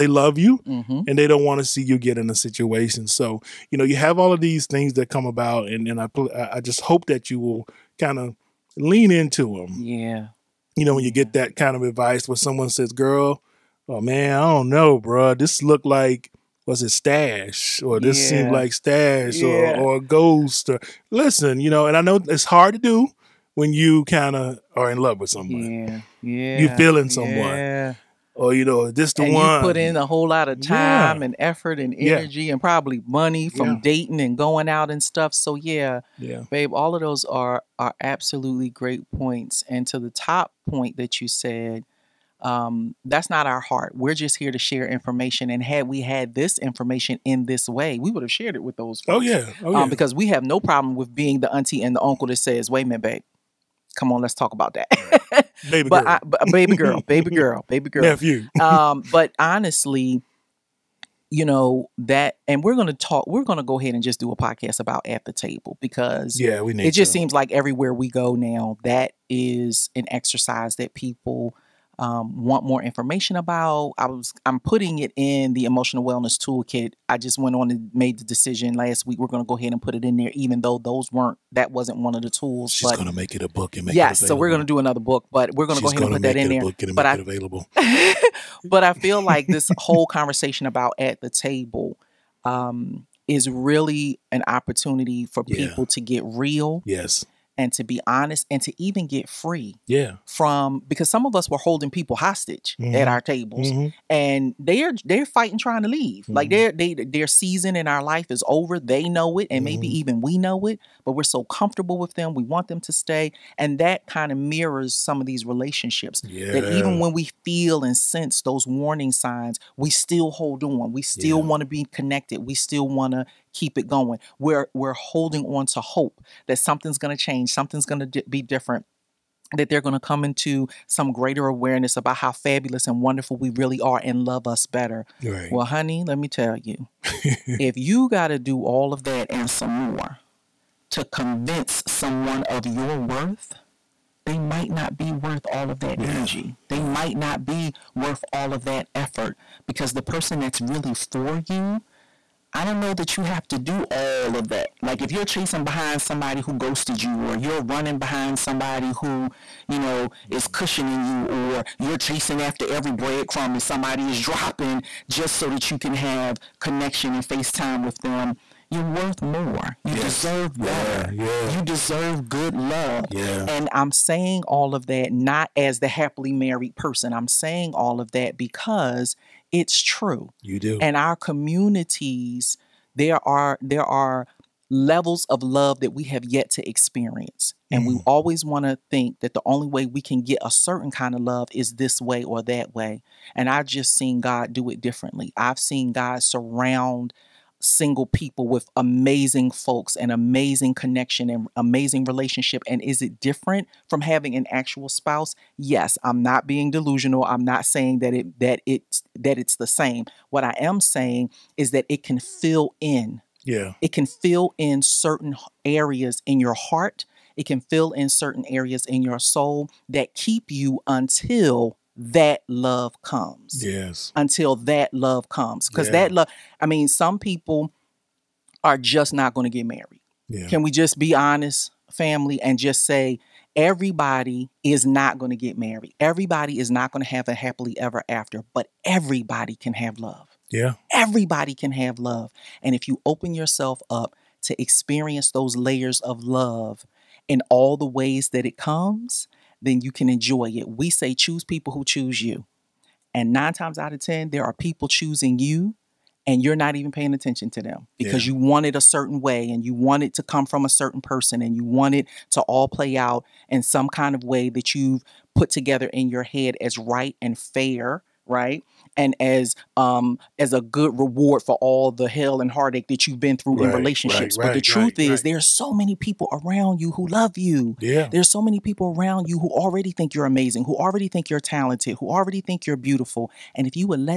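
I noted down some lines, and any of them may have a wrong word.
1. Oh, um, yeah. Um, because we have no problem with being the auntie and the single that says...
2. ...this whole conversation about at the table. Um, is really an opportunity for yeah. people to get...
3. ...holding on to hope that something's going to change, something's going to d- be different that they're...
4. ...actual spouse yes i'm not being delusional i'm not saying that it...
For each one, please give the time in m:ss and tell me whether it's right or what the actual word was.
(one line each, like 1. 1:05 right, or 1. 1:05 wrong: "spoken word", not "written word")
1. 0:49 wrong: "uncle", not "single"
2. 1:29 right
3. 2:04 right
4. 3:24 right.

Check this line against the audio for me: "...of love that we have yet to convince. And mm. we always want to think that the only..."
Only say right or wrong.
wrong.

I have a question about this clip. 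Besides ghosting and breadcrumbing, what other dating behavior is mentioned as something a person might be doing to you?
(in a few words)
Cushioning.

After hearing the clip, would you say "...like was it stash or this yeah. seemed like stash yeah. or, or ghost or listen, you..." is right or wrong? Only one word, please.
right.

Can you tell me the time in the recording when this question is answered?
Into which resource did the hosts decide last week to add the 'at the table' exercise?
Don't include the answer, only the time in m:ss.
1:15.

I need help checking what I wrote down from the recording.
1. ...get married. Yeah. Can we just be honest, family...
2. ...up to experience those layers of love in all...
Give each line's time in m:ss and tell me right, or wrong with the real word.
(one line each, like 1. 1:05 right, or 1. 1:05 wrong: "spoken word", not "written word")
1. 3:49 right
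2. 4:03 right.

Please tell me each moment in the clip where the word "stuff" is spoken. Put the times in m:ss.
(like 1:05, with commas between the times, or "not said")
0:35.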